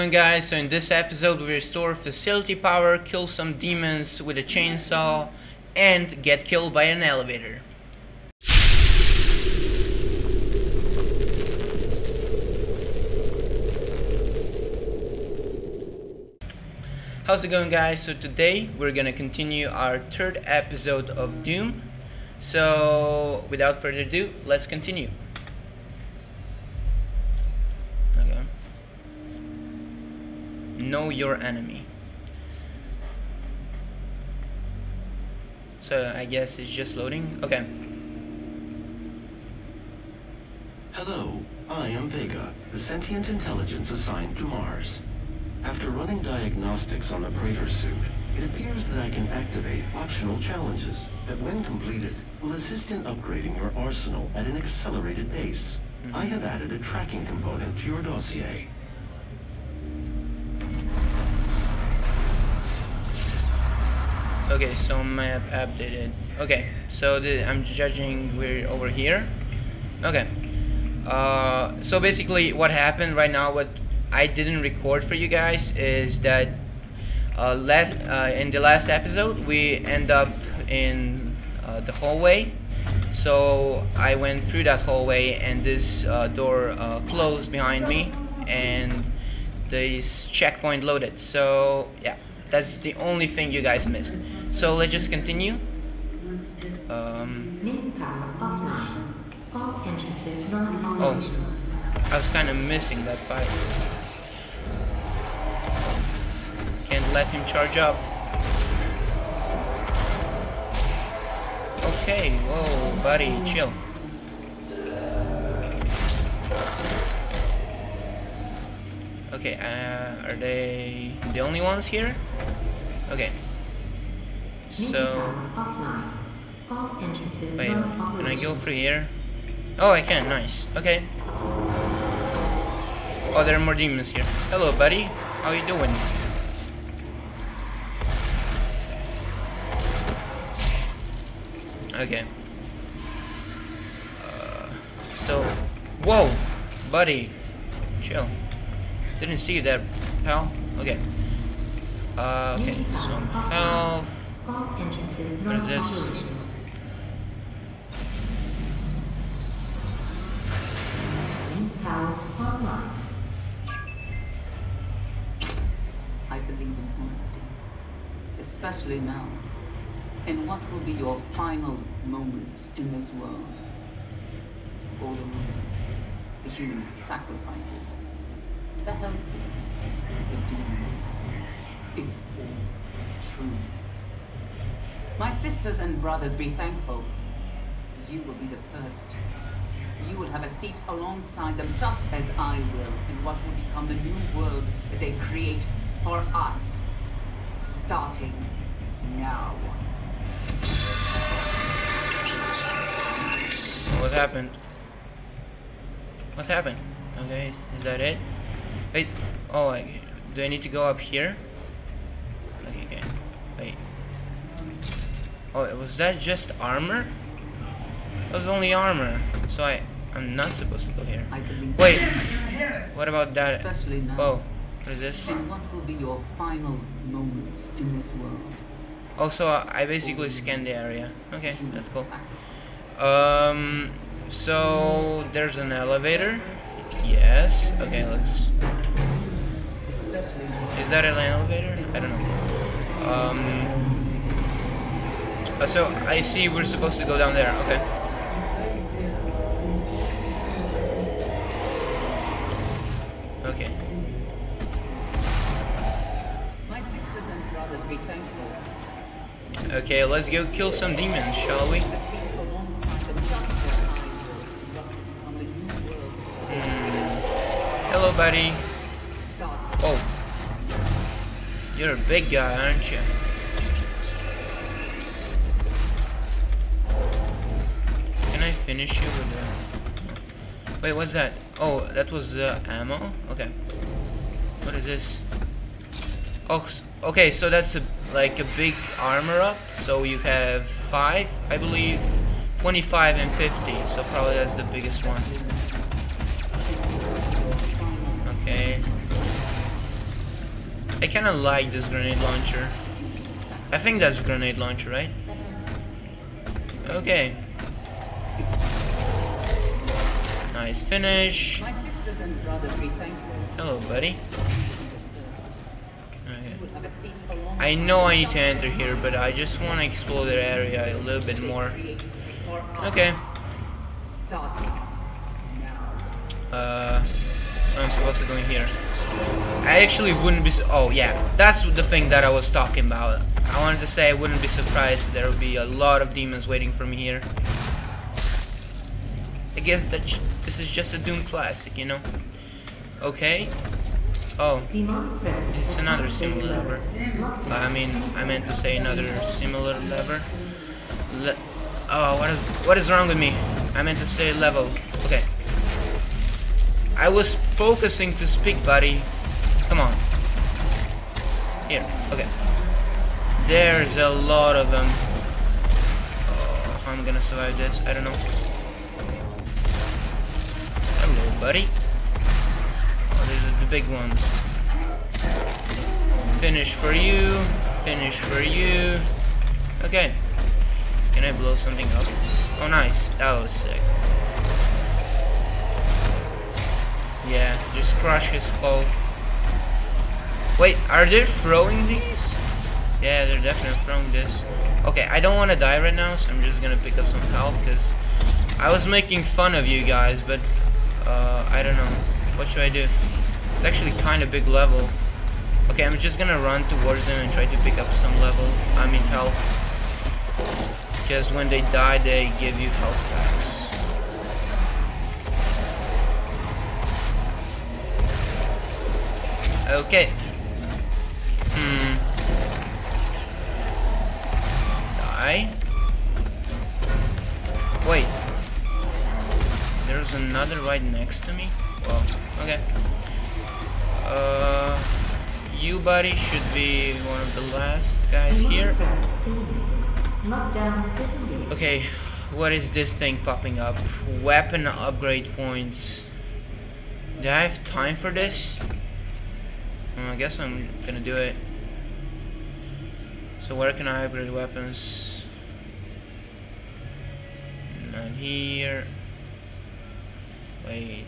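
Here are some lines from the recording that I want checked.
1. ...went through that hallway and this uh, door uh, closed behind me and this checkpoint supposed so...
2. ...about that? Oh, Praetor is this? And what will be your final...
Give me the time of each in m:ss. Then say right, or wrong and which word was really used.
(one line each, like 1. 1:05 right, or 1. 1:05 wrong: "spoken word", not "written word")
1. 1:24 wrong: "loaded", not "supposed"
2. 3:43 wrong: "What", not "Praetor".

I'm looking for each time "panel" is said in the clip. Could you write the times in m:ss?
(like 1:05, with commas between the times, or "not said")
not said.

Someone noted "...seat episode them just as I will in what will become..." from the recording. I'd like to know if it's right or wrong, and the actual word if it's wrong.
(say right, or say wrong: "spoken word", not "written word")
wrong: "alongside", not "episode".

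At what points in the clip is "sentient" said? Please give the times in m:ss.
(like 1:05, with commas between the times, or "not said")
0:42.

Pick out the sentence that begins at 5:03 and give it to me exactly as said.
I think that's grenade launcher, right?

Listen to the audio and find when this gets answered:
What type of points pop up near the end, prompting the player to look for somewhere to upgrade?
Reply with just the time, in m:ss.
7:24.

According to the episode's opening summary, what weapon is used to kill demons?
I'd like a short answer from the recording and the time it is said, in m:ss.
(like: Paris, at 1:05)
Chainsaw, at 0:04.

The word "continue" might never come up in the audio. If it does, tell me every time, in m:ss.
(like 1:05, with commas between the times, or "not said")
0:19, 0:24, 1:35.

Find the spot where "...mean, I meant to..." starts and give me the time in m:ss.
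5:47.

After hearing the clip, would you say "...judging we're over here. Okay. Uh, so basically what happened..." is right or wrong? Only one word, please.
right.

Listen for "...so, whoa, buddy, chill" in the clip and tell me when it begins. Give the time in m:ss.
2:25.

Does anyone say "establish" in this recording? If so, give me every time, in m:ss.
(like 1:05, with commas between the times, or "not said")
not said.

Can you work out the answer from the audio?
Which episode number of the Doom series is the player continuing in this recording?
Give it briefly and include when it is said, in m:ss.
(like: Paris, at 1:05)
3, at 0:19.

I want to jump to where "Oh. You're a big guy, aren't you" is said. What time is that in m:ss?
4:29.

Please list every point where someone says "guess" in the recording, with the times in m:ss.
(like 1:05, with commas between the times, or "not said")
0:36, 5:39, 7:30.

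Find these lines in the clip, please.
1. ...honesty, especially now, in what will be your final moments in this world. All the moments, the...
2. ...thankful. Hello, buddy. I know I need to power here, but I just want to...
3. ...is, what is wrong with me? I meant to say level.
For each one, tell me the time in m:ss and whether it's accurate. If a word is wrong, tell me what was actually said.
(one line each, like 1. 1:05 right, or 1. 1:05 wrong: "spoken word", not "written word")
1. 2:46 right
2. 5:12 wrong: "enter", not "power"
3. 5:52 right.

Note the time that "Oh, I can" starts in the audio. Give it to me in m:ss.
2:09.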